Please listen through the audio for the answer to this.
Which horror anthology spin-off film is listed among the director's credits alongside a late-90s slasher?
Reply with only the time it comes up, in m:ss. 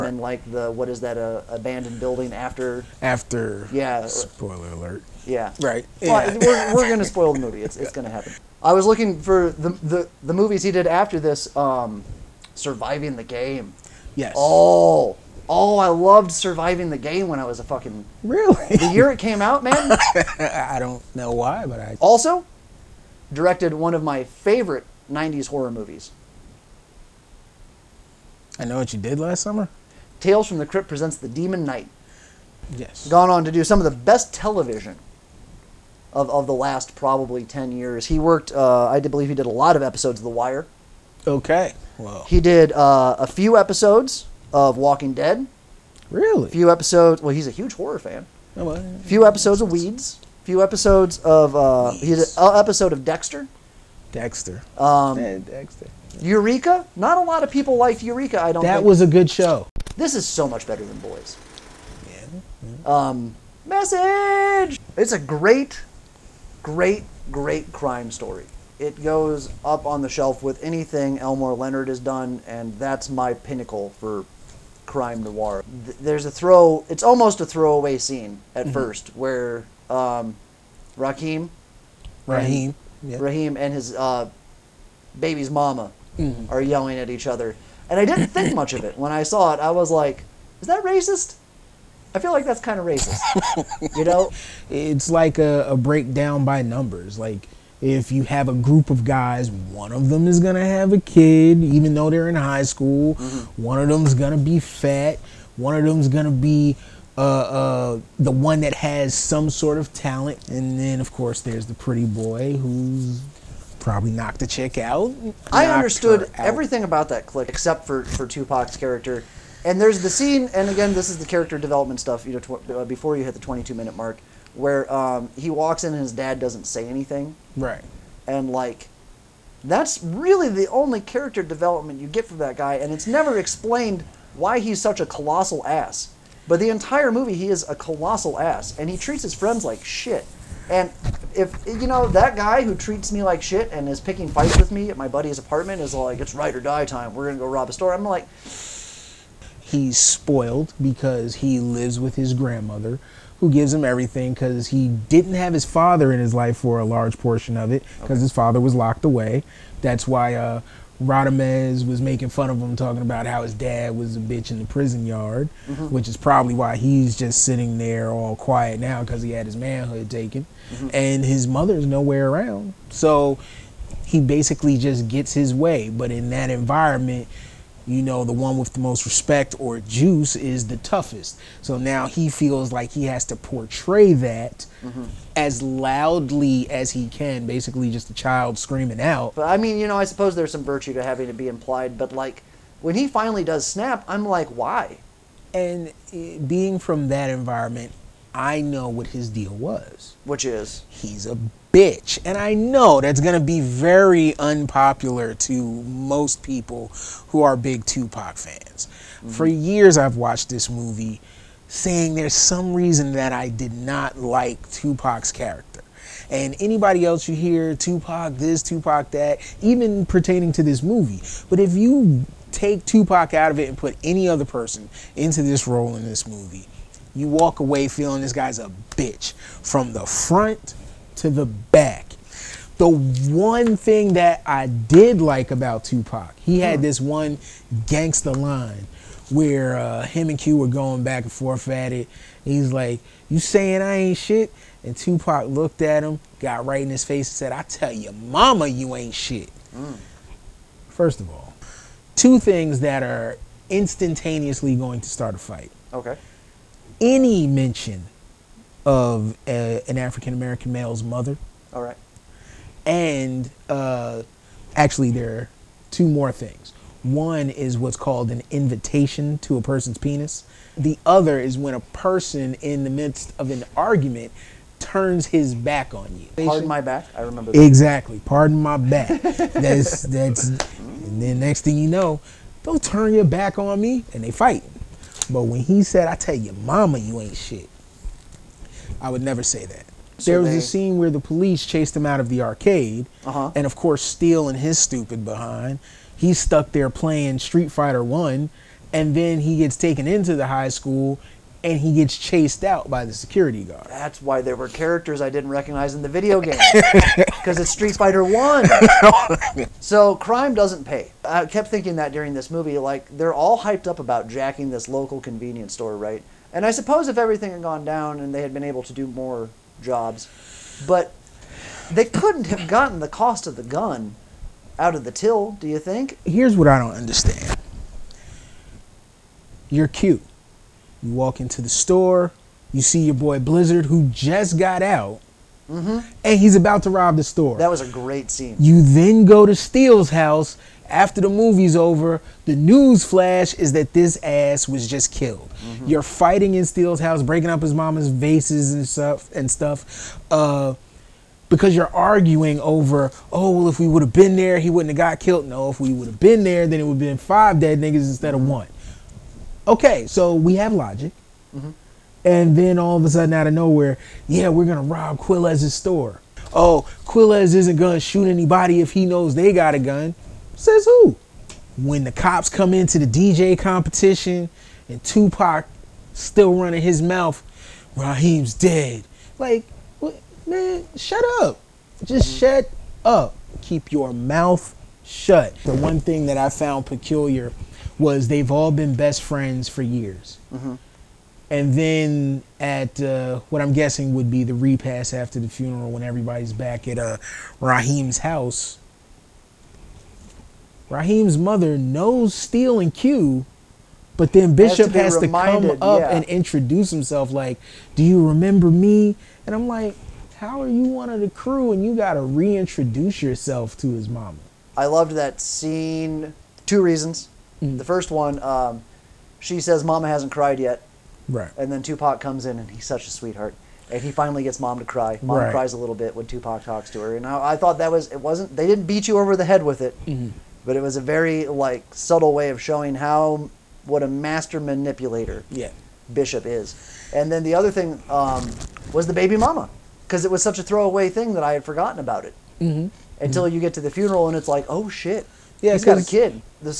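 0:30.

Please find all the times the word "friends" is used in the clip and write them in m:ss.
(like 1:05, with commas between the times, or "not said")
2:19, 6:29.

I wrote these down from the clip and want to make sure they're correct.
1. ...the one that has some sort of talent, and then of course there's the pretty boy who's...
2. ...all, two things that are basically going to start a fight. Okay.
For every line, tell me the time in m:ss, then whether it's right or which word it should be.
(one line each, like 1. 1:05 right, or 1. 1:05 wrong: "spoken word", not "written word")
1. 1:48 right
2. 4:11 wrong: "instantaneously", not "basically".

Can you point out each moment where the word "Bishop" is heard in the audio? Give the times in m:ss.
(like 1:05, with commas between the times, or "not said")
6:44, 7:16.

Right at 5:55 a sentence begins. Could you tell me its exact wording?
No, if we would have been there, then it would have been five dead niggas instead of one.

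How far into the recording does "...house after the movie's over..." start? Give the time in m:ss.
5:40.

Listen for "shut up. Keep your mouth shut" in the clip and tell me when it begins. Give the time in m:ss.
6:22.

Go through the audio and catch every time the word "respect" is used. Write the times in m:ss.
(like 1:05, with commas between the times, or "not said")
2:59.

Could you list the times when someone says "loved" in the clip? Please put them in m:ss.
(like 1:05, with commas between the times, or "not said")
0:15, 6:54.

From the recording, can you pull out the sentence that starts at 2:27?
We're gonna go rob a store.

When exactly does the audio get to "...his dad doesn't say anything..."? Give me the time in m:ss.
2:06.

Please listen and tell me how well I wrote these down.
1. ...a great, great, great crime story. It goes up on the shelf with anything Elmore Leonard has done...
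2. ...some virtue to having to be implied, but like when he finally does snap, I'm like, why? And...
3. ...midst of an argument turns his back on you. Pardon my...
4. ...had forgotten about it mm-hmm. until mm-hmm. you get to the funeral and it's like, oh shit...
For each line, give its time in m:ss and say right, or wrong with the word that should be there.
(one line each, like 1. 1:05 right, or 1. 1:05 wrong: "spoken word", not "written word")
1. 1:05 right
2. 3:10 right
3. 4:32 right
4. 7:21 right.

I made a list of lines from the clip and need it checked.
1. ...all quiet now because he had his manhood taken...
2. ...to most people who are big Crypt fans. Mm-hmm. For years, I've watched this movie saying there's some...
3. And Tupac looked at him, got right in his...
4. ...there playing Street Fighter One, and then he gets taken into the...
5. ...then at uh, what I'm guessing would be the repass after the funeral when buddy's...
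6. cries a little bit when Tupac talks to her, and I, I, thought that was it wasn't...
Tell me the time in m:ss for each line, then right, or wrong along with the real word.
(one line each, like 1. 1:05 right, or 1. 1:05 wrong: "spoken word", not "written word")
1. 2:48 right
2. 3:25 wrong: "Tupac", not "Crypt"
3. 4:04 right
4. 4:56 right
5. 6:31 wrong: "everybody", not "buddy"
6. 7:05 right.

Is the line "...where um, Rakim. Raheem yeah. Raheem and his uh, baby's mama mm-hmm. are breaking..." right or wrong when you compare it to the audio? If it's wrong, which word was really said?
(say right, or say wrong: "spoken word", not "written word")
wrong: "yelling", not "breaking".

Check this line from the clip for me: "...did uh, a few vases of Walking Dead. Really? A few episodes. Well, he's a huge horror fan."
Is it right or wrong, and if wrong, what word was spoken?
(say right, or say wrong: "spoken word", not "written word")
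wrong: "episodes", not "vases".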